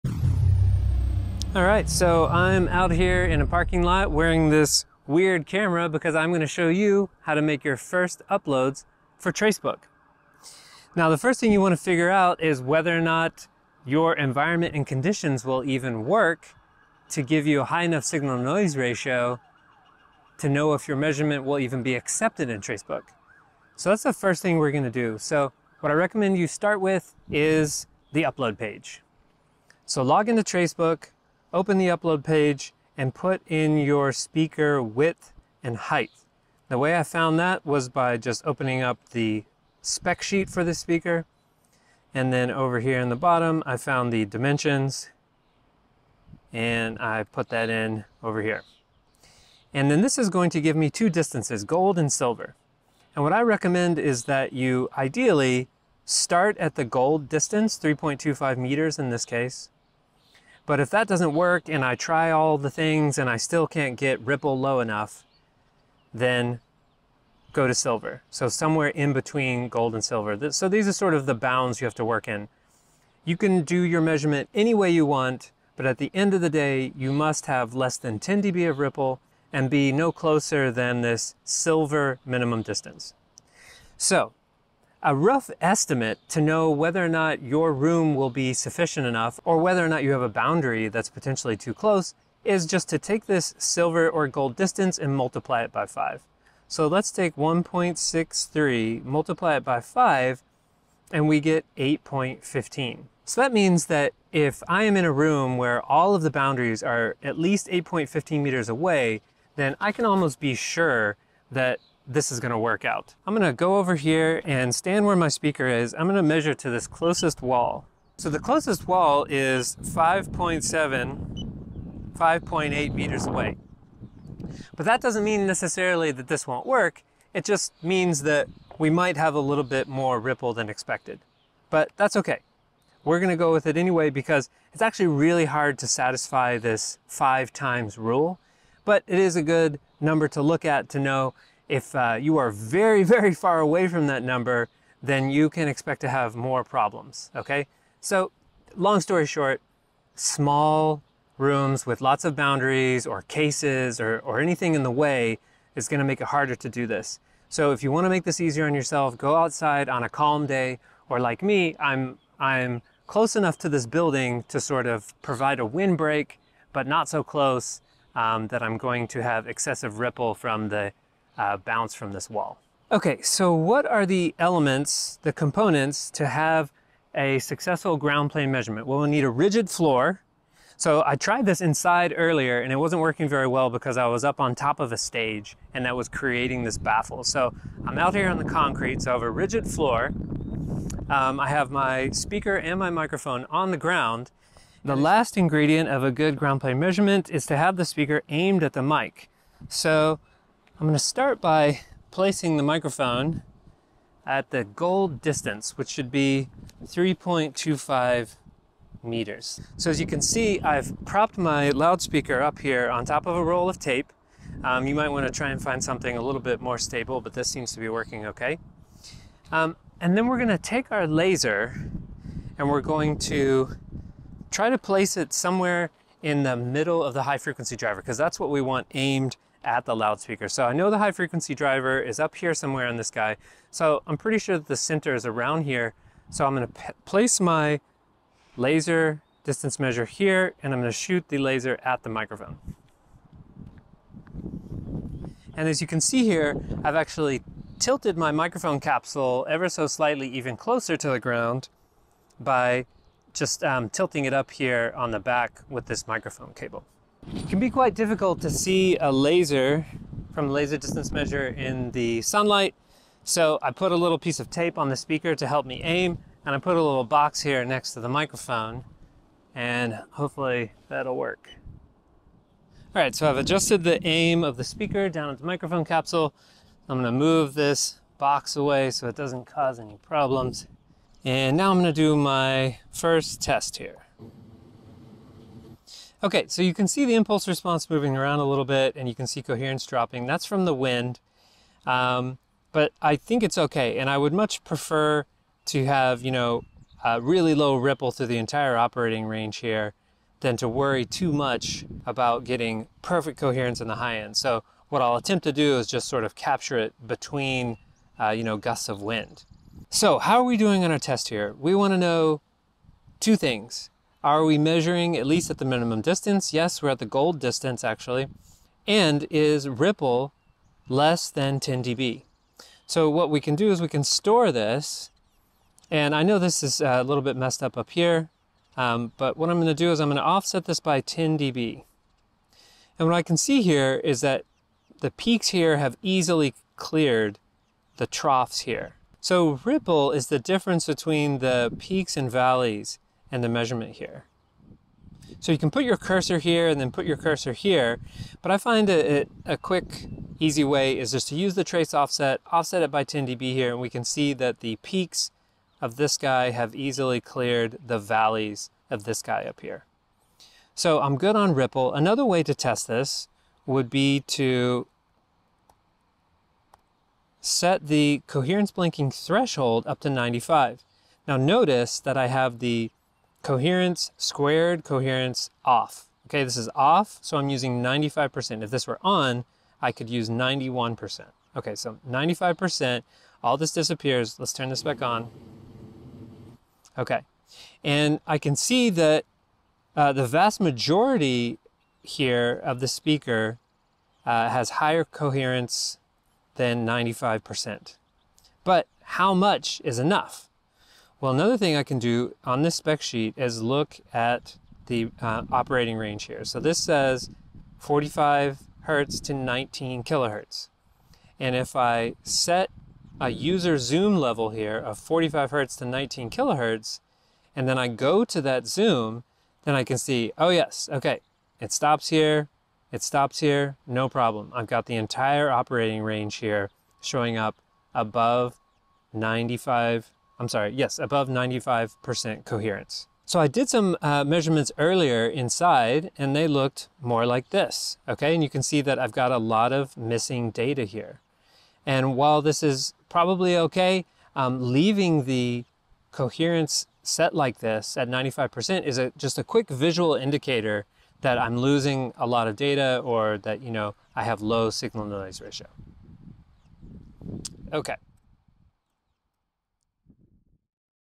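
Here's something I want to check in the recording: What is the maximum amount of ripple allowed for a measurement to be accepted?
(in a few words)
10 dB.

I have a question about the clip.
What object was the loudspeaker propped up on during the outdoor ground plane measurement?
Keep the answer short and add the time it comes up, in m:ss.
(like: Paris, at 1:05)
a roll of tape, at 3:33.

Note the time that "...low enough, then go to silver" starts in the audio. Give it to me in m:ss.
1:04.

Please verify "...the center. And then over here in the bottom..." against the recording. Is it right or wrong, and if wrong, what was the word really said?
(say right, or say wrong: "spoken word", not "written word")
wrong: "speaker", not "center".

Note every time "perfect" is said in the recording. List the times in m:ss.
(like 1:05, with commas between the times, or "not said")
5:03.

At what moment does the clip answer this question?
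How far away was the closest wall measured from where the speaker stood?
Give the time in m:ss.
2:02.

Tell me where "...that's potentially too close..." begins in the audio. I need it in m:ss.
1:30.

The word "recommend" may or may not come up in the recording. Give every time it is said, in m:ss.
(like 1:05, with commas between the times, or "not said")
0:25, 0:53.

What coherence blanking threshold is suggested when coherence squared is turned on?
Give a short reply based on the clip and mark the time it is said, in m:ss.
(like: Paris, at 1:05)
91%, at 6:20.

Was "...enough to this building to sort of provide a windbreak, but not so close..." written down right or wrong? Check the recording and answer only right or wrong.
right.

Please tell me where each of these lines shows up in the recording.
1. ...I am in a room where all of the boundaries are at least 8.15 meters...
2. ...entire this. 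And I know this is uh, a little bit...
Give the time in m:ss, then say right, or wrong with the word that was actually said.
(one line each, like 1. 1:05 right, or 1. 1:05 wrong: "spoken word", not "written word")
1. 1:44 right
2. 5:24 wrong: "store", not "entire".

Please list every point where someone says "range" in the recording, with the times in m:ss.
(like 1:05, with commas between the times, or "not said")
4:59, 6:45, 7:06.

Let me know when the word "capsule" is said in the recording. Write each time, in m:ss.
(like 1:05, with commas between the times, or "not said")
4:08, 4:35.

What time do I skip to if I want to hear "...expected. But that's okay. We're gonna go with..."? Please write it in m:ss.
2:10.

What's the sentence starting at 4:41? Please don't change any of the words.
And now I'm gonna do my first test here.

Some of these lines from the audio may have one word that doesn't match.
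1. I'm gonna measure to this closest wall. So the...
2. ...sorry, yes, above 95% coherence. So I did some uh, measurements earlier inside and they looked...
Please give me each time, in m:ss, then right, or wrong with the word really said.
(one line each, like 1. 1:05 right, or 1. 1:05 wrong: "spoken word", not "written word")
1. 1:55 right
2. 7:10 right.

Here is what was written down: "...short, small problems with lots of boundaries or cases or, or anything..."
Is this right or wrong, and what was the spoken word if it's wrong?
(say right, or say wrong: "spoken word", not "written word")
wrong: "rooms", not "problems".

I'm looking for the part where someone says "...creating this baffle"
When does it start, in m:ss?
3:06.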